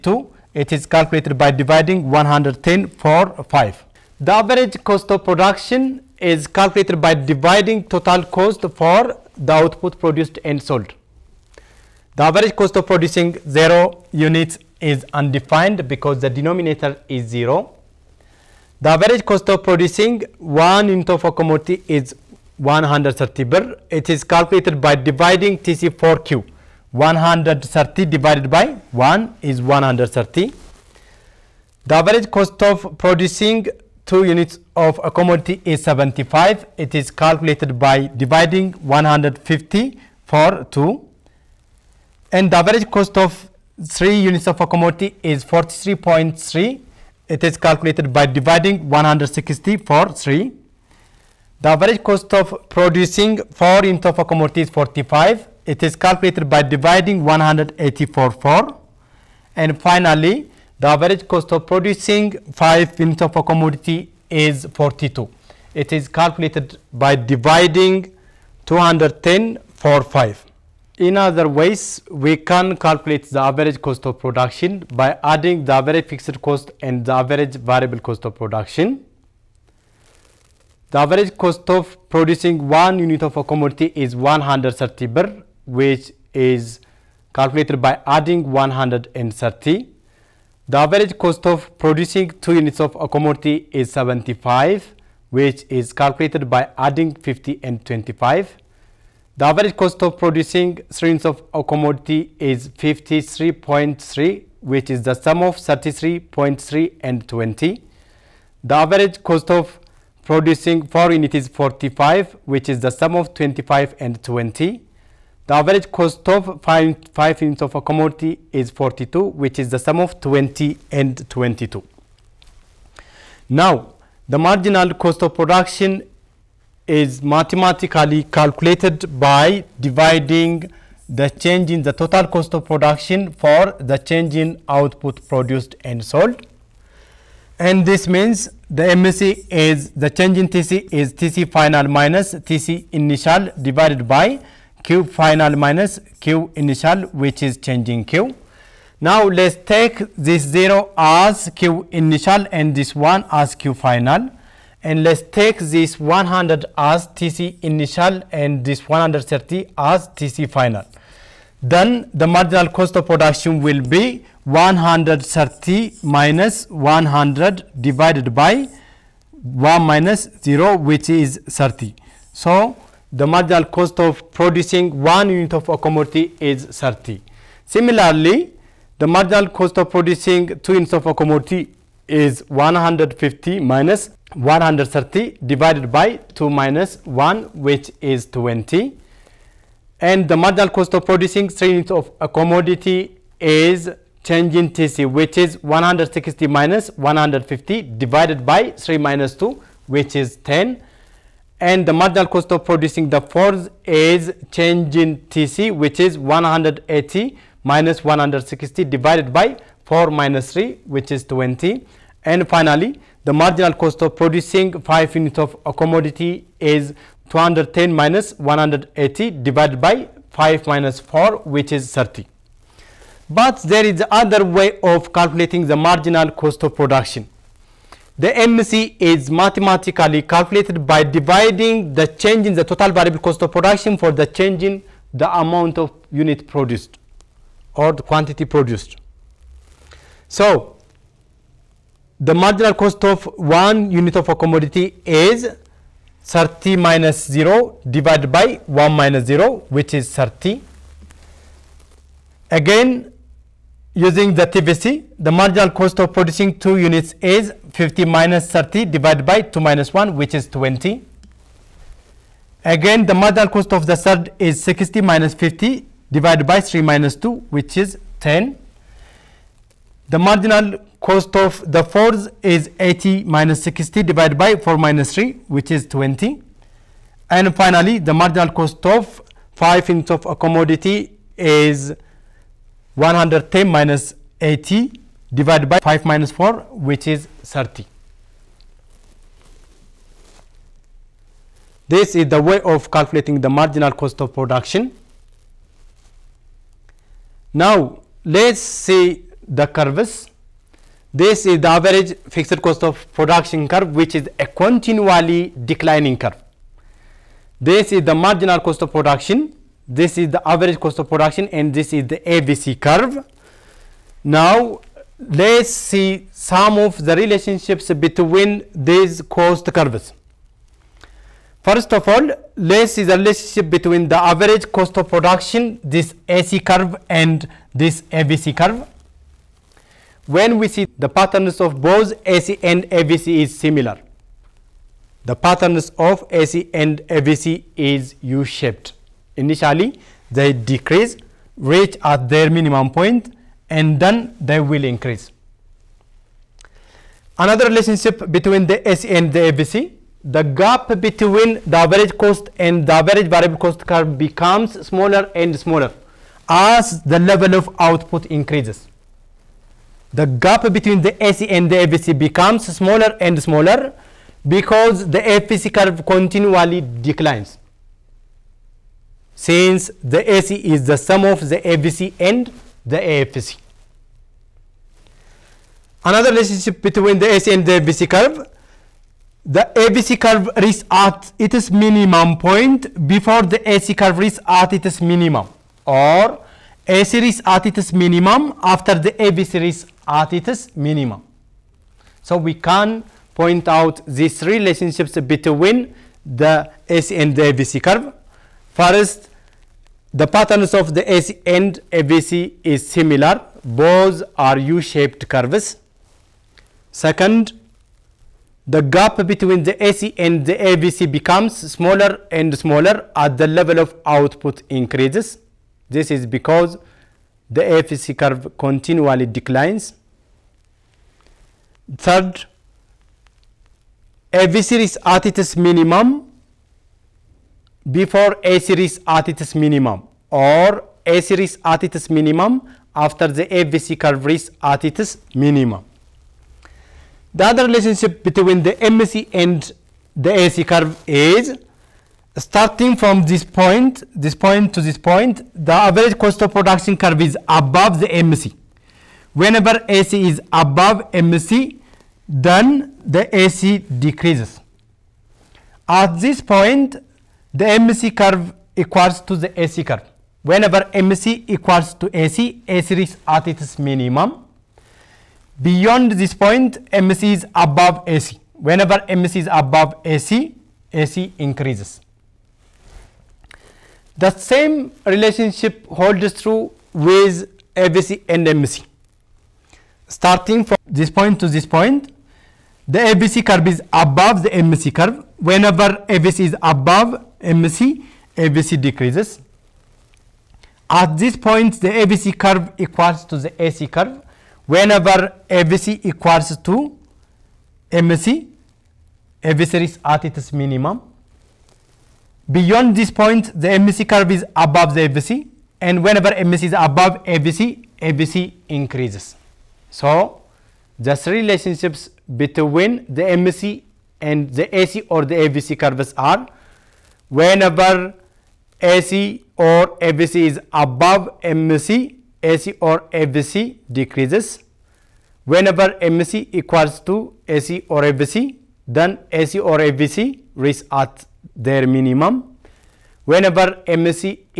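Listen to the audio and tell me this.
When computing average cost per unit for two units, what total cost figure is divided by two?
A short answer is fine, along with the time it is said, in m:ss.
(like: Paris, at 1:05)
150, at 0:38.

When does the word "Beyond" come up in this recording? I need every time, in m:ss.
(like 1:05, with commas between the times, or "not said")
7:45, 8:22.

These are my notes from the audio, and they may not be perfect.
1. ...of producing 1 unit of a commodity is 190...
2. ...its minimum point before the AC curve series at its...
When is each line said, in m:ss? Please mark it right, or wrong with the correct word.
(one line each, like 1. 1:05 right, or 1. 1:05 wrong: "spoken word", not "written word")
1. 0:19 wrong: "130", not "190"
2. 6:21 wrong: "reaches", not "series".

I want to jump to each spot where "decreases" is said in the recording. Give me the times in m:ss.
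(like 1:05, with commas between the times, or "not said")
5:40, 7:33, 8:08, 8:43.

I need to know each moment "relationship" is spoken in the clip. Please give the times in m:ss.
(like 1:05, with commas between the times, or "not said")
5:17, 5:23, 5:47, 6:16, 6:34, 7:17, 7:55, 8:31.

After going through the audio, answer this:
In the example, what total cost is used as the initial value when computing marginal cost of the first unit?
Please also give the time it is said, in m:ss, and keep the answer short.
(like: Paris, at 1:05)
100, at 2:35.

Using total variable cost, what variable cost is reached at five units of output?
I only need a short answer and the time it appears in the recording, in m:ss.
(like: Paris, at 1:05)
110, at 4:42.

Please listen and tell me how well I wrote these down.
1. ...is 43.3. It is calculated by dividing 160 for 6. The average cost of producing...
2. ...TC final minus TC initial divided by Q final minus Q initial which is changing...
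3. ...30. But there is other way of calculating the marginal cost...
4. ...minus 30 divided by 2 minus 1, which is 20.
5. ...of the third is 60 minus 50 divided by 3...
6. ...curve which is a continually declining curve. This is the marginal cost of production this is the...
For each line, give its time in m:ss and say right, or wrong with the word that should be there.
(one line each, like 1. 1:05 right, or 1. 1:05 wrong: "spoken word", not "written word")
1. 0:45 wrong: "3", not "6"
2. 2:21 right
3. 3:41 right
4. 4:18 right
5. 4:23 right
6. 5:03 right.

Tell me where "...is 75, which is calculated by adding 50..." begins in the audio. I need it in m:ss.
1:33.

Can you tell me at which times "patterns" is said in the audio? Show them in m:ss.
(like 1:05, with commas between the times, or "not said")
5:31, 5:35, 6:40.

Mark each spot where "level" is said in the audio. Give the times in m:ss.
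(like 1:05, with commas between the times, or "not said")
5:57, 6:53.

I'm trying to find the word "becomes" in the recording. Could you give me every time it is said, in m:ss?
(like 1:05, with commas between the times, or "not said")
5:54, 6:02, 6:51.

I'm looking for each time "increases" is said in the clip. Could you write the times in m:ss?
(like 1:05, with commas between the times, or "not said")
5:44, 5:58, 6:54, 7:51, 8:28.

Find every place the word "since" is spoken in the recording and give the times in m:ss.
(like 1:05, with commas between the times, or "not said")
6:09.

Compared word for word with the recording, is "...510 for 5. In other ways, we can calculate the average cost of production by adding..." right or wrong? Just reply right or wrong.
wrong.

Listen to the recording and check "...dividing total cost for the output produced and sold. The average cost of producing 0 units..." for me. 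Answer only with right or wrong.
right.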